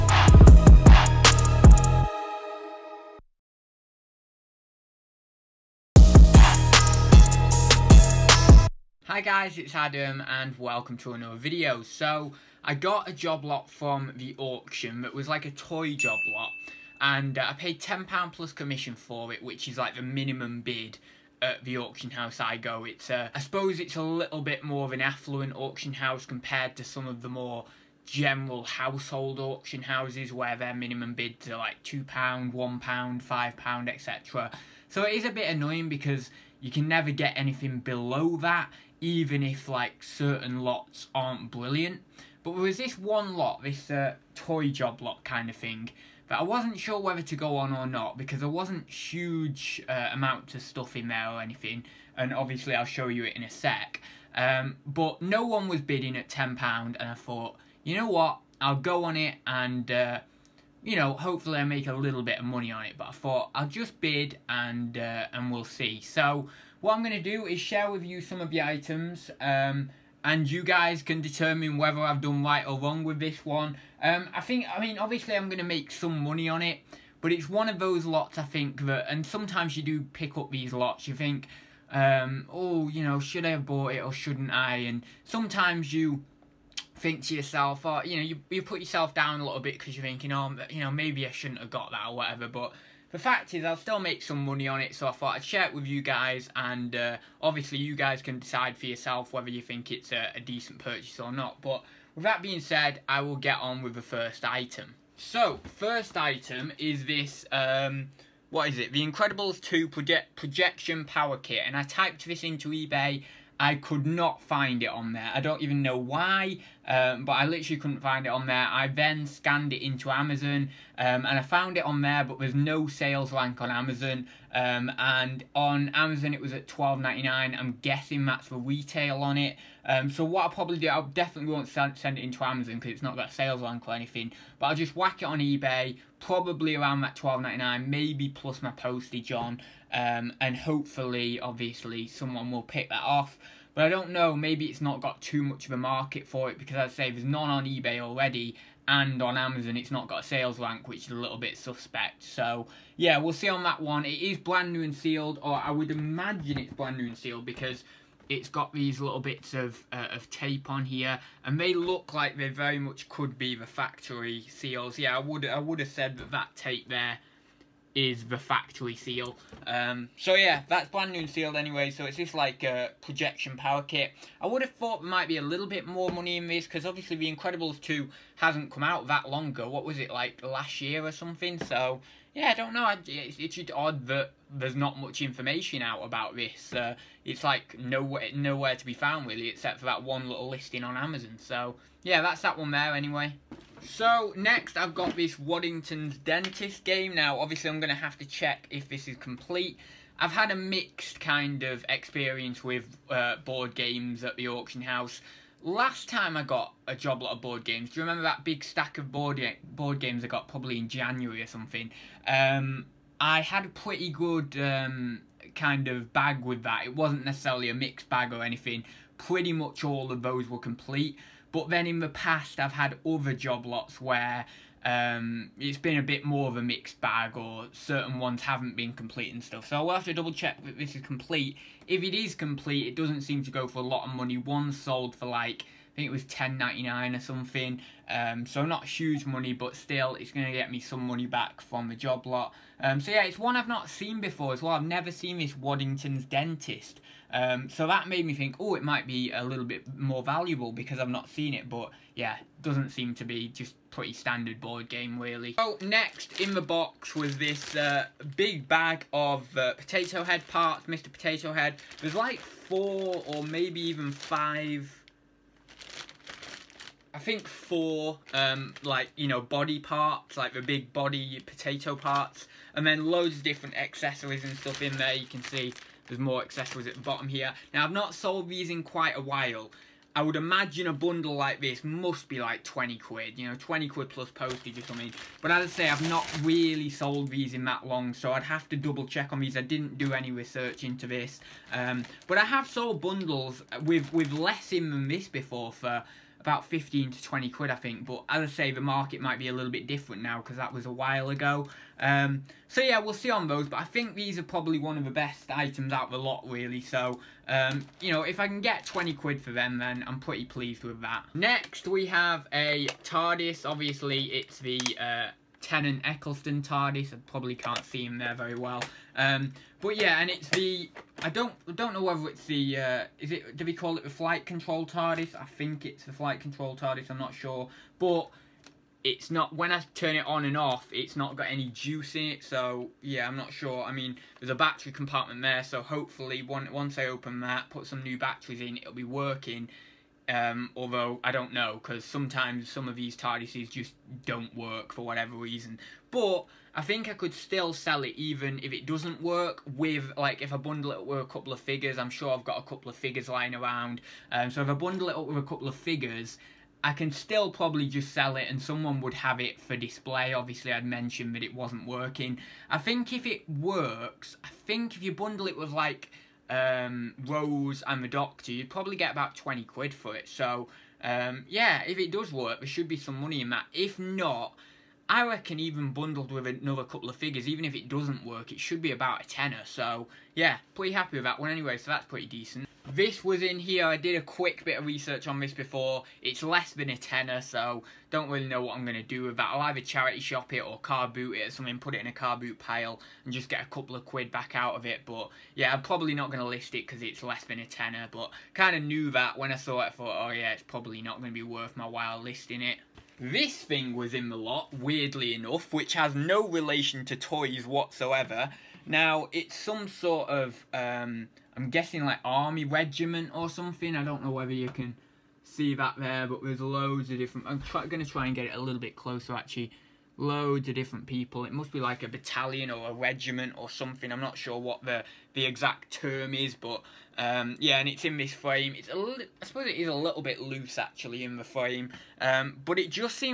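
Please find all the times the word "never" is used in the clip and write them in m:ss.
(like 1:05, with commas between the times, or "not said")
0:36, 4:04.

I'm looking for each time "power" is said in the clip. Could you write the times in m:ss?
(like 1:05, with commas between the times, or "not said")
1:51, 2:53.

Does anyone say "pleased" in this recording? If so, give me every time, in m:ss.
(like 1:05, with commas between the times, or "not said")
5:10.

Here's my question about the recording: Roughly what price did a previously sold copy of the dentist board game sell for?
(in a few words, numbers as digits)
£10.99.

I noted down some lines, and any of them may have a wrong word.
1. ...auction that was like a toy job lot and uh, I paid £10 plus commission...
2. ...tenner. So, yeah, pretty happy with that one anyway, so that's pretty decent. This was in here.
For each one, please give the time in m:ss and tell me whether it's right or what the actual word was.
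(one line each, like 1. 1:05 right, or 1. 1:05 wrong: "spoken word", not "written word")
1. 0:14 right
2. 6:19 right.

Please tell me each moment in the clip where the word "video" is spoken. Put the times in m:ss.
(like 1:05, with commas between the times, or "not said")
0:11.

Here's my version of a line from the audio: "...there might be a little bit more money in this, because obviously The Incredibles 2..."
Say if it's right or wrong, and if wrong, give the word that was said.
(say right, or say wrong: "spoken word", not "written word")
right.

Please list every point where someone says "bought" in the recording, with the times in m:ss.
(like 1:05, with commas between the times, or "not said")
1:23.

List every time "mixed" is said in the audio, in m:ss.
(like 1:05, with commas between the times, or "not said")
3:20, 3:37, 3:46.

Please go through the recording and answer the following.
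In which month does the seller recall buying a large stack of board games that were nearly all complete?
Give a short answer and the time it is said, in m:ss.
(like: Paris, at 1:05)
January, at 3:30.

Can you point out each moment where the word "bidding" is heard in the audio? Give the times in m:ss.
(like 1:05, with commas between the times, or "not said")
0:55.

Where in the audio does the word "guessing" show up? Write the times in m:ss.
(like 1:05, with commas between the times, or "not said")
2:07, 6:51.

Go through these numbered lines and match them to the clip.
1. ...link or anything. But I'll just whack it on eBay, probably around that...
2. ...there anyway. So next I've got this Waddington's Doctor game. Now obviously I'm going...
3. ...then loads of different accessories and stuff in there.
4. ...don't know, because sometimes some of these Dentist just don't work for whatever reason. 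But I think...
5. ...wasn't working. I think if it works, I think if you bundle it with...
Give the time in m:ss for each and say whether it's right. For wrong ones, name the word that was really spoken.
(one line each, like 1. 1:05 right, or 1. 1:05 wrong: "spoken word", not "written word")
1. 2:13 right
2. 3:12 wrong: "Dentist", not "Doctor"
3. 4:32 right
4. 5:41 wrong: "TARDISes", not "Dentist"
5. 6:01 right.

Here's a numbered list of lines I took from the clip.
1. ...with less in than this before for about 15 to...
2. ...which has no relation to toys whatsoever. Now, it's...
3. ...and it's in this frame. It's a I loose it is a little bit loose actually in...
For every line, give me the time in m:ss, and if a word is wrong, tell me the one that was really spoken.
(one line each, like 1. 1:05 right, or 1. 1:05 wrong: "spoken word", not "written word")
1. 4:54 right
2. 6:45 right
3. 7:07 wrong: "suppose", not "loose".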